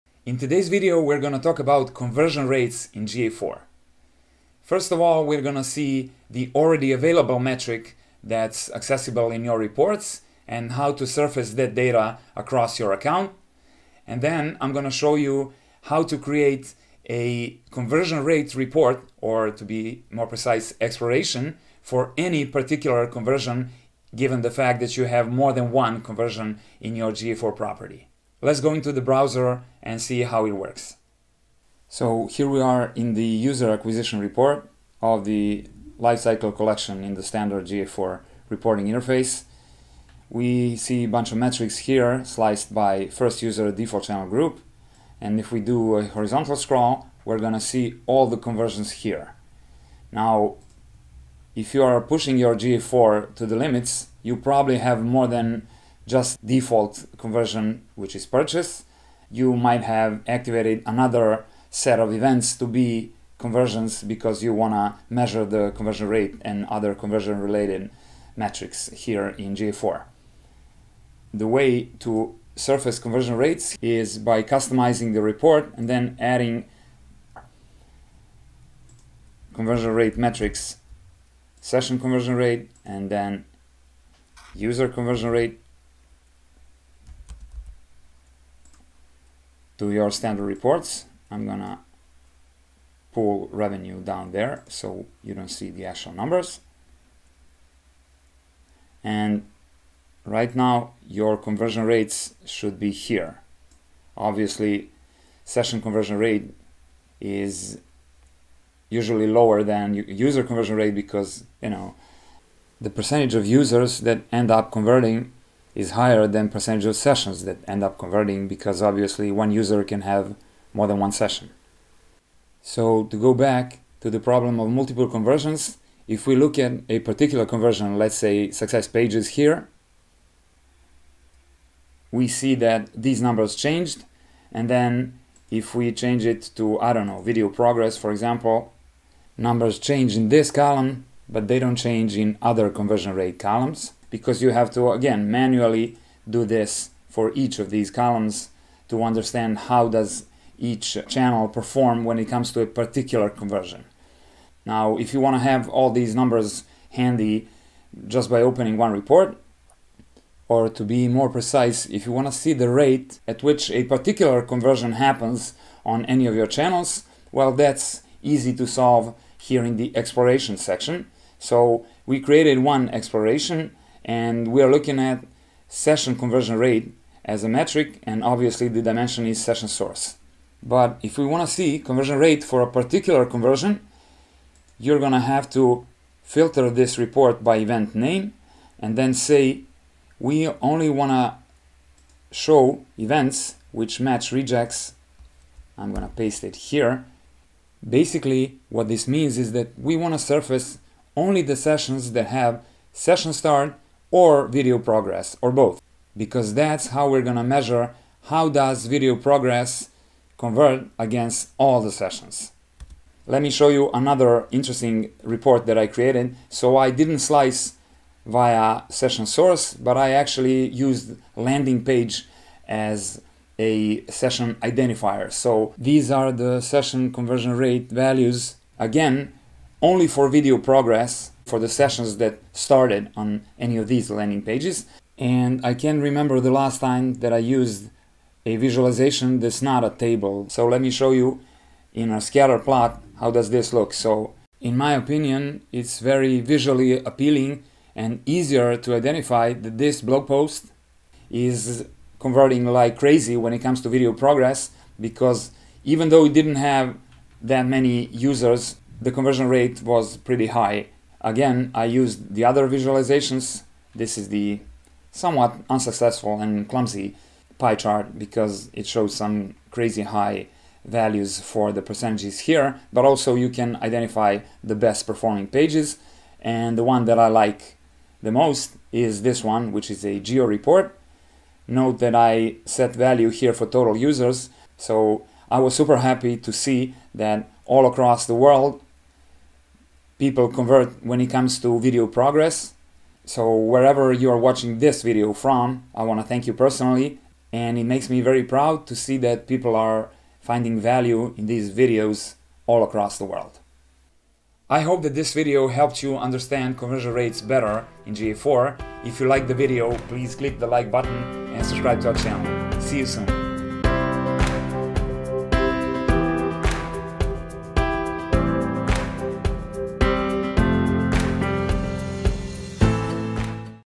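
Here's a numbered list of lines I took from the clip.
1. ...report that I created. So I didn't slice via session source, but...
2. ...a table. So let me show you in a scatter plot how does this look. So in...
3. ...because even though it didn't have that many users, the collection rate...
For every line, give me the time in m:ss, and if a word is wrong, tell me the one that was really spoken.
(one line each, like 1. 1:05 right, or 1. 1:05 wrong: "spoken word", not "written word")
1. 3:35 right
2. 3:59 right
3. 4:15 wrong: "conversion", not "collection".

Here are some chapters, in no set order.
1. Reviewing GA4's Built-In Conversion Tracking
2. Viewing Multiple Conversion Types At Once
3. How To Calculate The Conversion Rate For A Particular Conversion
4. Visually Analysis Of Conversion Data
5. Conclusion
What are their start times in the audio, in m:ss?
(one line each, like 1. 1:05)
1. 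0:32
2. 2:37
3. 3:01
4. 3:36
5. 5:06.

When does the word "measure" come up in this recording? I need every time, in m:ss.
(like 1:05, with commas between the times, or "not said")
1:05, 3:27.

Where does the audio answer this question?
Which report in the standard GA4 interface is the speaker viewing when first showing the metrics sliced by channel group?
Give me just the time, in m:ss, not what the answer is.
0:33.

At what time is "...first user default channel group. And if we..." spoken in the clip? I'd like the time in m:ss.
0:43.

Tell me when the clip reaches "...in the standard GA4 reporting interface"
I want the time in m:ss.
0:37.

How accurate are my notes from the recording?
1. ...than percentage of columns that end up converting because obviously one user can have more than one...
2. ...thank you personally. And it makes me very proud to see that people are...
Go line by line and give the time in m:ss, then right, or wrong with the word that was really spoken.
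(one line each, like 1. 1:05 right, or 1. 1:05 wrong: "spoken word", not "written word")
1. 1:56 wrong: "sessions", not "columns"
2. 4:56 right.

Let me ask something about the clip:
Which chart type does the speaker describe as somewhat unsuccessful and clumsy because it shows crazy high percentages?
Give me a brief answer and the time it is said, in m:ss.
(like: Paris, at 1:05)
Pie chart, at 4:27.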